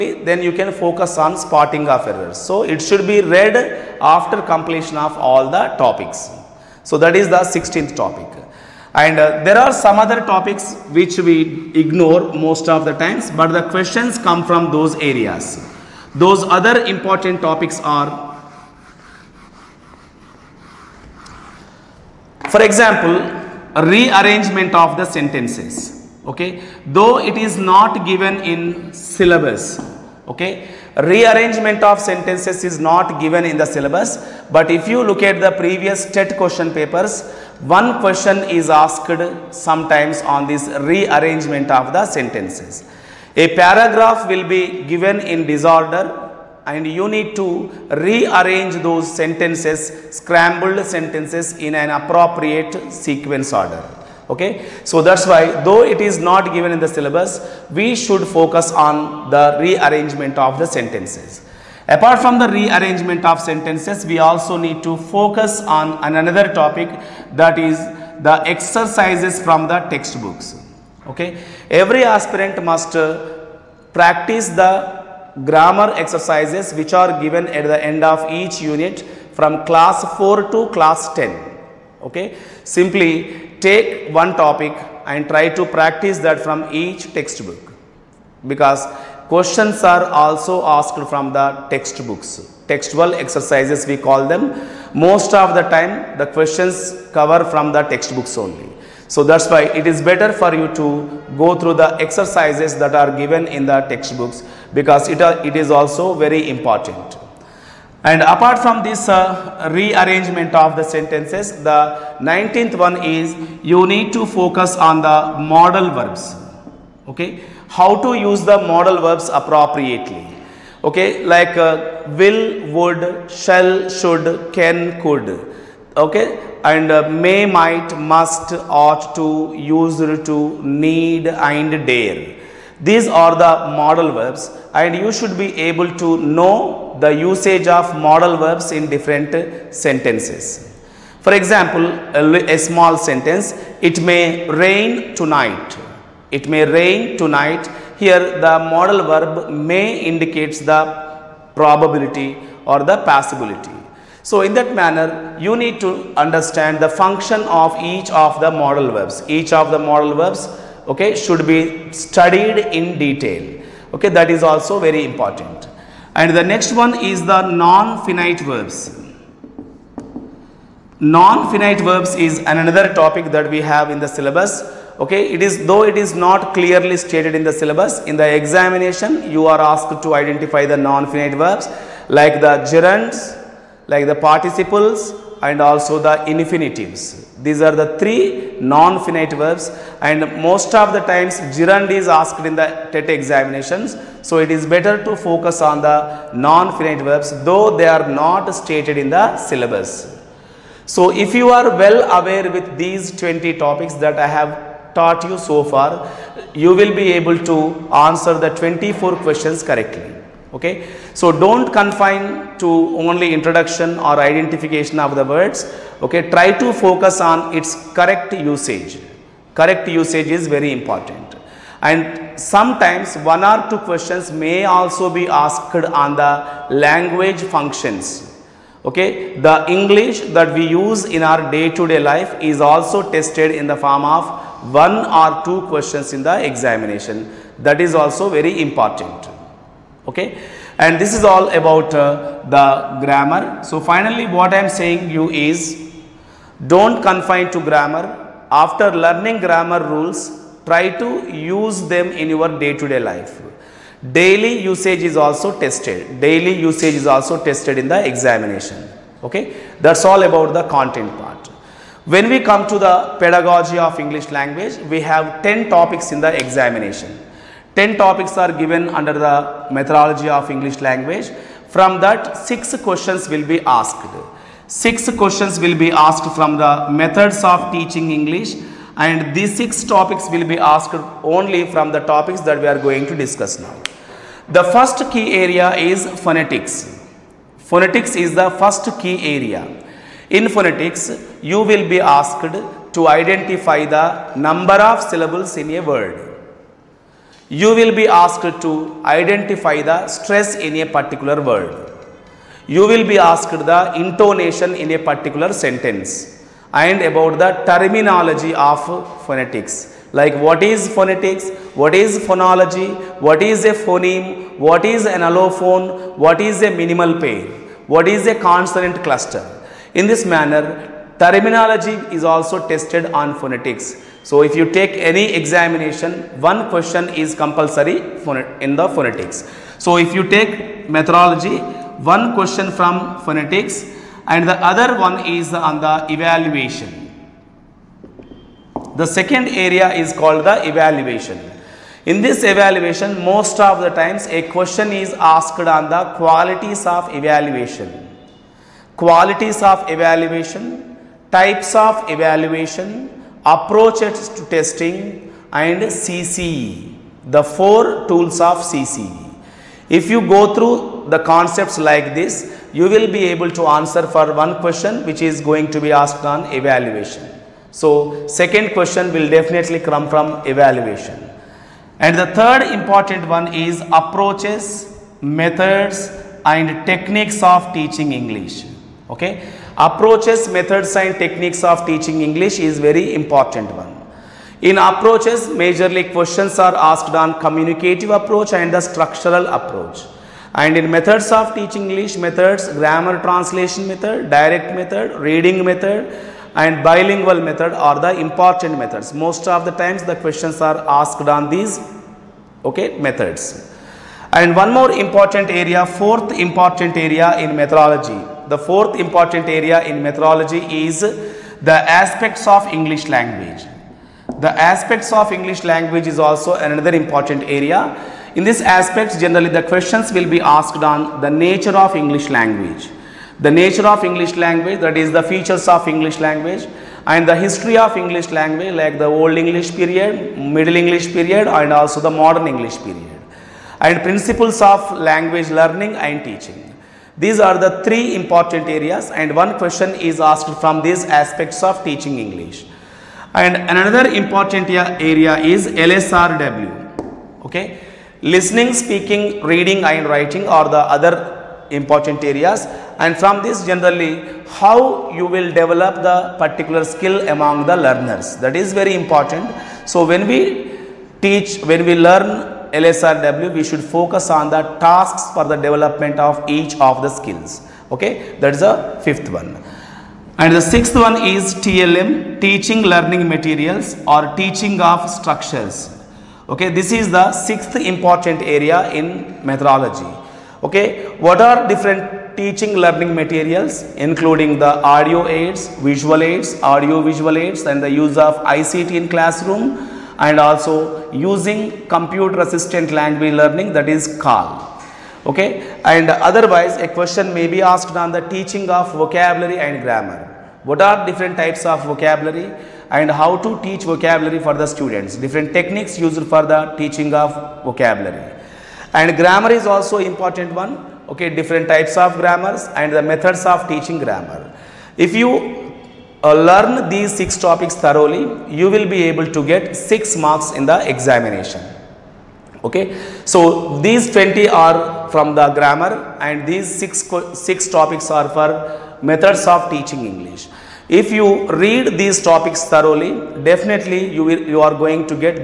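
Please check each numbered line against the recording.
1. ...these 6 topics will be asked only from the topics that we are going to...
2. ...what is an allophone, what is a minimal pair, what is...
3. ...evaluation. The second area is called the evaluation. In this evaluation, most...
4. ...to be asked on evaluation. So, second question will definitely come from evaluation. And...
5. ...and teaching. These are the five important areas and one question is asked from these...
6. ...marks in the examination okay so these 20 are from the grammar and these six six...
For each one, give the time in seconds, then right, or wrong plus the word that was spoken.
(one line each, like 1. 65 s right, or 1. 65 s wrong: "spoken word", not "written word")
1. 279 s right
2. 314 s right
3. 336 s right
4. 365 s right
5. 435 s wrong: "three", not "five"
6. 520 s right.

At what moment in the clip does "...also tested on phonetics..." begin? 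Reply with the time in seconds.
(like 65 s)
322 s.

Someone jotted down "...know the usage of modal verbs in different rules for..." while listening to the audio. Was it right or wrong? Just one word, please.
wrong.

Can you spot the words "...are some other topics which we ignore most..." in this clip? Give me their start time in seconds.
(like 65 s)
9 s.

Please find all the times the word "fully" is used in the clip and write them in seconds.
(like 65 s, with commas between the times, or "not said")
not said.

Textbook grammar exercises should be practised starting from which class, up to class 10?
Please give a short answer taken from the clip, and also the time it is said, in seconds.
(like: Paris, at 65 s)
Class 4, at 79 s.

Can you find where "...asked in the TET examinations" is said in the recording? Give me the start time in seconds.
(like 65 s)
192 s.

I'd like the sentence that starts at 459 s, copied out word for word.
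So, when we teach, when we learn LSRW, we should focus on the tasks for the development of each of the skills.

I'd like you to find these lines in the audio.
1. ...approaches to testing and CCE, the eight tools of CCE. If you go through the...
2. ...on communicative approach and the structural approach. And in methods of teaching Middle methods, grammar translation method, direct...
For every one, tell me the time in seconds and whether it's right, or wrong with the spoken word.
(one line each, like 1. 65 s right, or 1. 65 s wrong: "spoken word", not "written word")
1. 353 s wrong: "four", not "eight"
2. 387 s wrong: "English", not "Middle".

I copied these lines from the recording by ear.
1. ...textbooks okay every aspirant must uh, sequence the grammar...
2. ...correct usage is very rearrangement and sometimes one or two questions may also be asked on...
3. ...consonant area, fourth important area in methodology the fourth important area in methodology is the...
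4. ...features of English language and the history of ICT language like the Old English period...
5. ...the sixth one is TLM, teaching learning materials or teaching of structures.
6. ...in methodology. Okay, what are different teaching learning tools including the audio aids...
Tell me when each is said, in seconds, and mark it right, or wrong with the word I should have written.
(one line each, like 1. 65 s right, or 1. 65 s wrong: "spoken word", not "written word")
1. 69 s wrong: "practice", not "sequence"
2. 219 s wrong: "important", not "rearrangement"
3. 404 s wrong: "important", not "consonant"
4. 425 s wrong: "English", not "ICT"
5. 470 s right
6. 478 s wrong: "materials", not "tools".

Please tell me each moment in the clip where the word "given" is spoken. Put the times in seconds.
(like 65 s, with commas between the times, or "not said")
28 s, 33 s, 44 s, 56 s, 77 s, 103 s, 268 s.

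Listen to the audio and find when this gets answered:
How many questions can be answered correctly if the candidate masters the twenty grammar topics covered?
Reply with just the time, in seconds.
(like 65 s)
208 s.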